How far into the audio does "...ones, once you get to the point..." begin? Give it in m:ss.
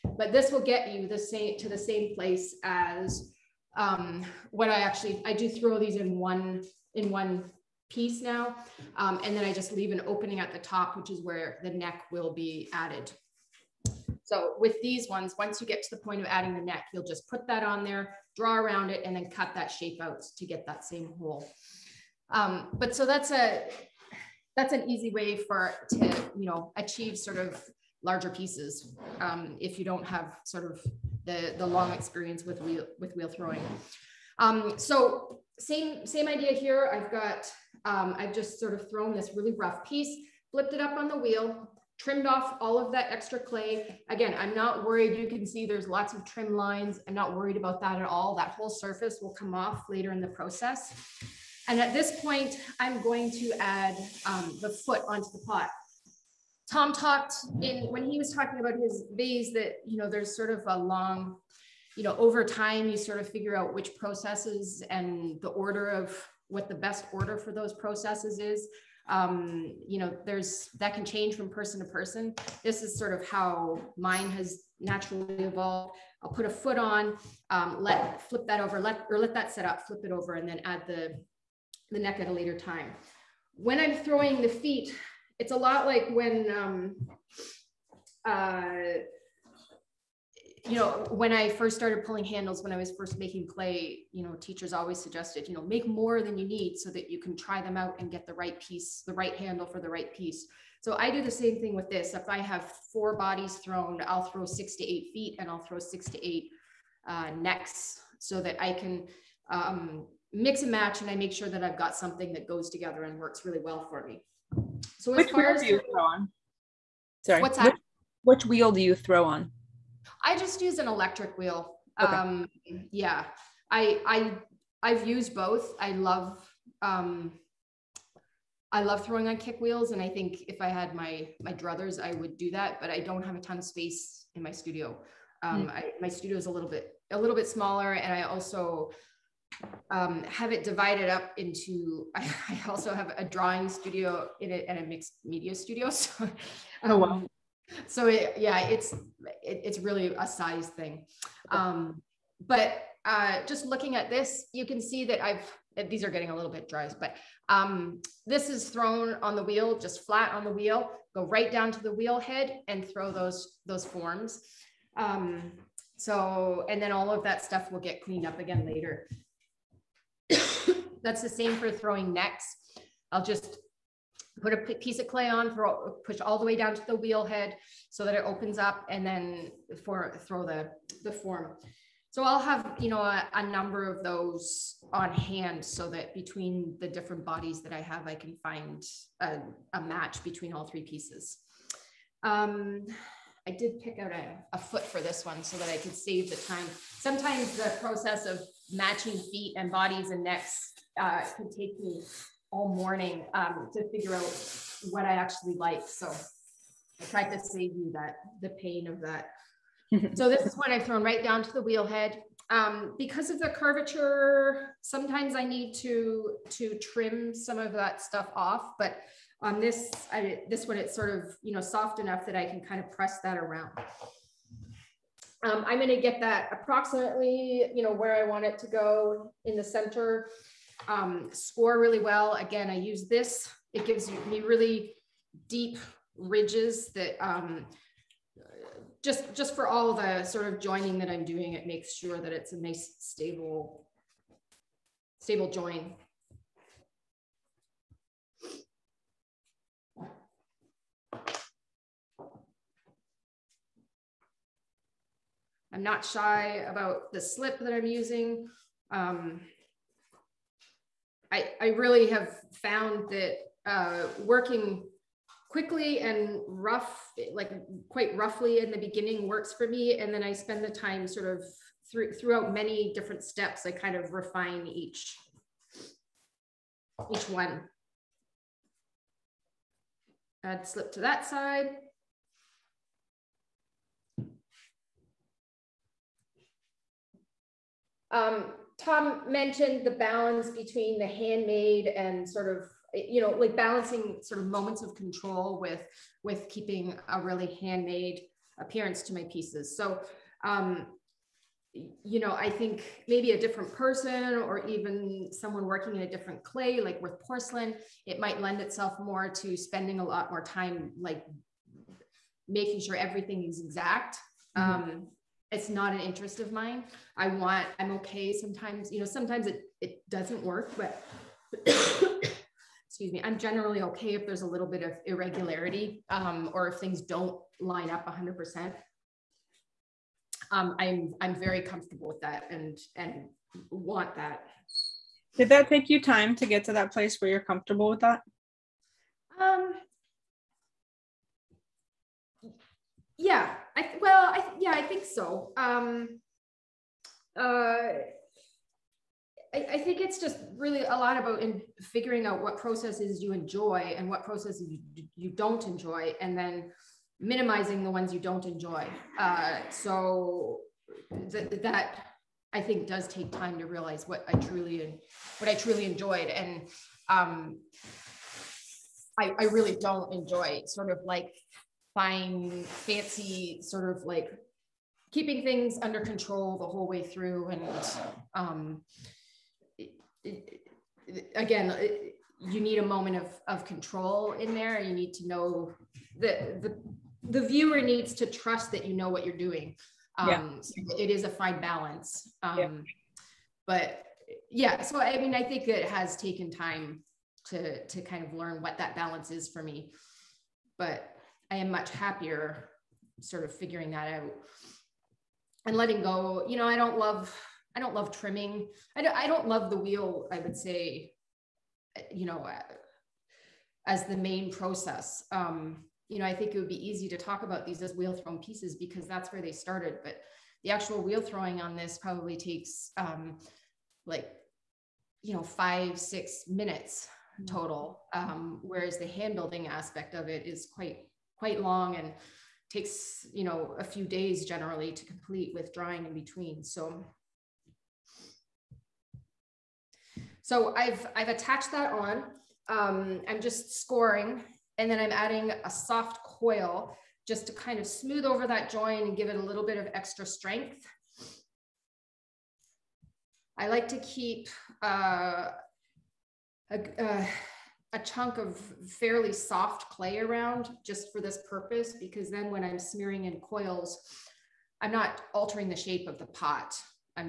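0:15.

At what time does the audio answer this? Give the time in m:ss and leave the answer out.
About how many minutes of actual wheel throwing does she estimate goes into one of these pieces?
7:05.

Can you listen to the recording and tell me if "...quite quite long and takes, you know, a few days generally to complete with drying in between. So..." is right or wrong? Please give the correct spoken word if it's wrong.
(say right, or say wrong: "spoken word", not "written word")
right.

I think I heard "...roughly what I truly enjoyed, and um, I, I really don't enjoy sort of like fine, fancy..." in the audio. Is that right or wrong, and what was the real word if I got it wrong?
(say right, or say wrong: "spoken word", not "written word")
wrong: "truly", not "roughly".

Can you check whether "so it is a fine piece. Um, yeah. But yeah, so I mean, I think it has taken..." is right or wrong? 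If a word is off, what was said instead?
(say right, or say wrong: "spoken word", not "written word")
wrong: "balance", not "piece".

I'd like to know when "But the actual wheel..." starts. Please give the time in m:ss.
7:00.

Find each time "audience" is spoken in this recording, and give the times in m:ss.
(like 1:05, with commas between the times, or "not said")
not said.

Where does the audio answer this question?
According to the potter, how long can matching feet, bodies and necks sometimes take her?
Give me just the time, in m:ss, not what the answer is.
3:22.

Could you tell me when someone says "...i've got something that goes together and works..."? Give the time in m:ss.
1:51.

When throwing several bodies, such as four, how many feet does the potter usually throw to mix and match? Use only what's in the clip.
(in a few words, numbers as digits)
6 to 8.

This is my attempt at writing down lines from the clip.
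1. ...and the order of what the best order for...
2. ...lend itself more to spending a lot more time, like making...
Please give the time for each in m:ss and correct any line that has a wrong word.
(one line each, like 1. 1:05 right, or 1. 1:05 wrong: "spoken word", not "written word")
1. 1:04 right
2. 5:08 right.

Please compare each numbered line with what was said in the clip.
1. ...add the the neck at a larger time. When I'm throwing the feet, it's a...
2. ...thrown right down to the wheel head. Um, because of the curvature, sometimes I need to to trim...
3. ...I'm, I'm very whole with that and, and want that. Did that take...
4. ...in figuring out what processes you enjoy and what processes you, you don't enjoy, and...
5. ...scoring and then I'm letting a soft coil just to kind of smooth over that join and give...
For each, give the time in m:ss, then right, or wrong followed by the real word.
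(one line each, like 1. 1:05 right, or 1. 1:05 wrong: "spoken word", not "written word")
1. 1:20 wrong: "later", not "larger"
2. 3:30 right
3. 5:30 wrong: "comfortable", not "whole"
4. 5:51 right
5. 7:23 wrong: "adding", not "letting".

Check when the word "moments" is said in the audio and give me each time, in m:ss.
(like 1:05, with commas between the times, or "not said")
4:54, 6:22.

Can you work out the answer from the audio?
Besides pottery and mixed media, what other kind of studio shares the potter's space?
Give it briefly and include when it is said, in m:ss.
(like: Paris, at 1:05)
Drawing studio, at 2:23.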